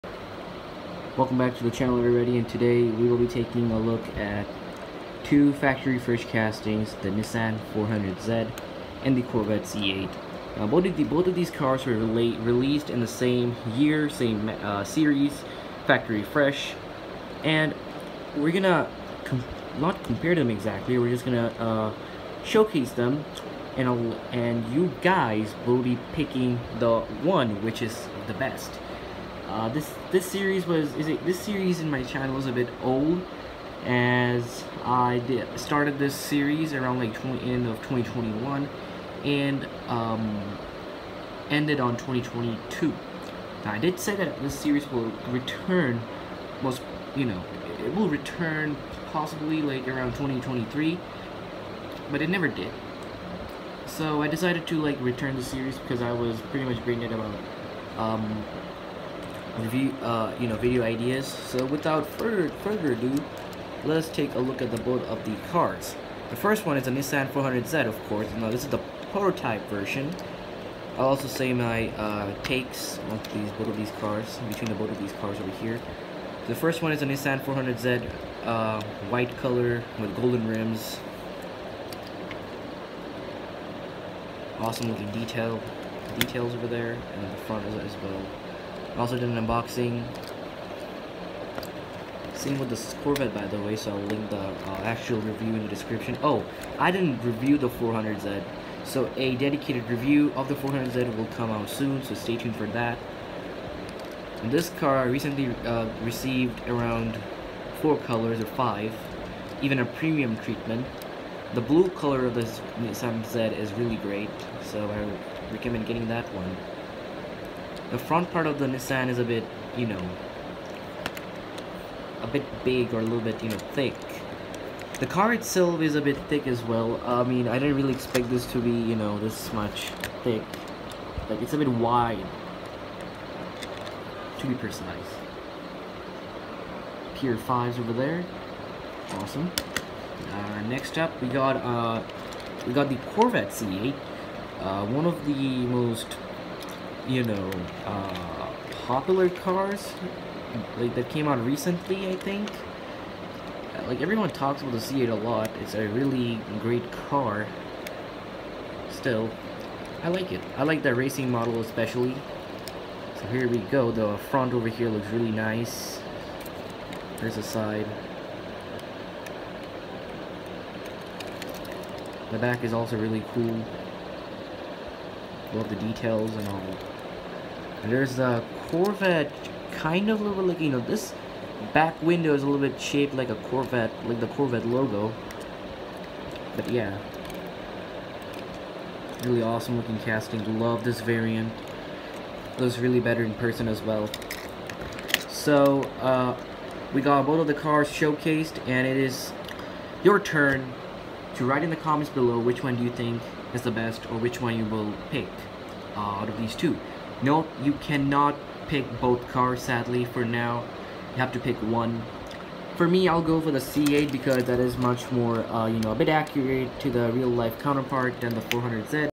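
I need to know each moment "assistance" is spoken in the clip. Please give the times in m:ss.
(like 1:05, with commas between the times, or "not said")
not said.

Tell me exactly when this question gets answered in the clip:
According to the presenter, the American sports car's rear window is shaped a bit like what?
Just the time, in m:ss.
3:04.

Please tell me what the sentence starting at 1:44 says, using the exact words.
And this car I recently uh, received around four colors or five, even a premium treatment.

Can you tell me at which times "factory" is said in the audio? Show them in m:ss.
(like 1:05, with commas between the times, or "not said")
0:05, 0:15.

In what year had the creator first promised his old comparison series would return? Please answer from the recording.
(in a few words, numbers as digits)
2023.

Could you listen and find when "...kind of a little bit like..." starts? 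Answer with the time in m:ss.
2:59.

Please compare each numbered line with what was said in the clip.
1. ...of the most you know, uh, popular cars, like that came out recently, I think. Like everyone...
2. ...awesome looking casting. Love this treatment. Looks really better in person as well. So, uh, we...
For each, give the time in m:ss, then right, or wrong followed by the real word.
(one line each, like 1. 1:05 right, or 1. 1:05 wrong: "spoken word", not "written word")
1. 2:25 right
2. 3:09 wrong: "variant", not "treatment".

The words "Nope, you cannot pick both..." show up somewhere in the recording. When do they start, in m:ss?
3:27.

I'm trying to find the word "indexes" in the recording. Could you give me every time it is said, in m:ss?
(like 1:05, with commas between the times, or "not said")
not said.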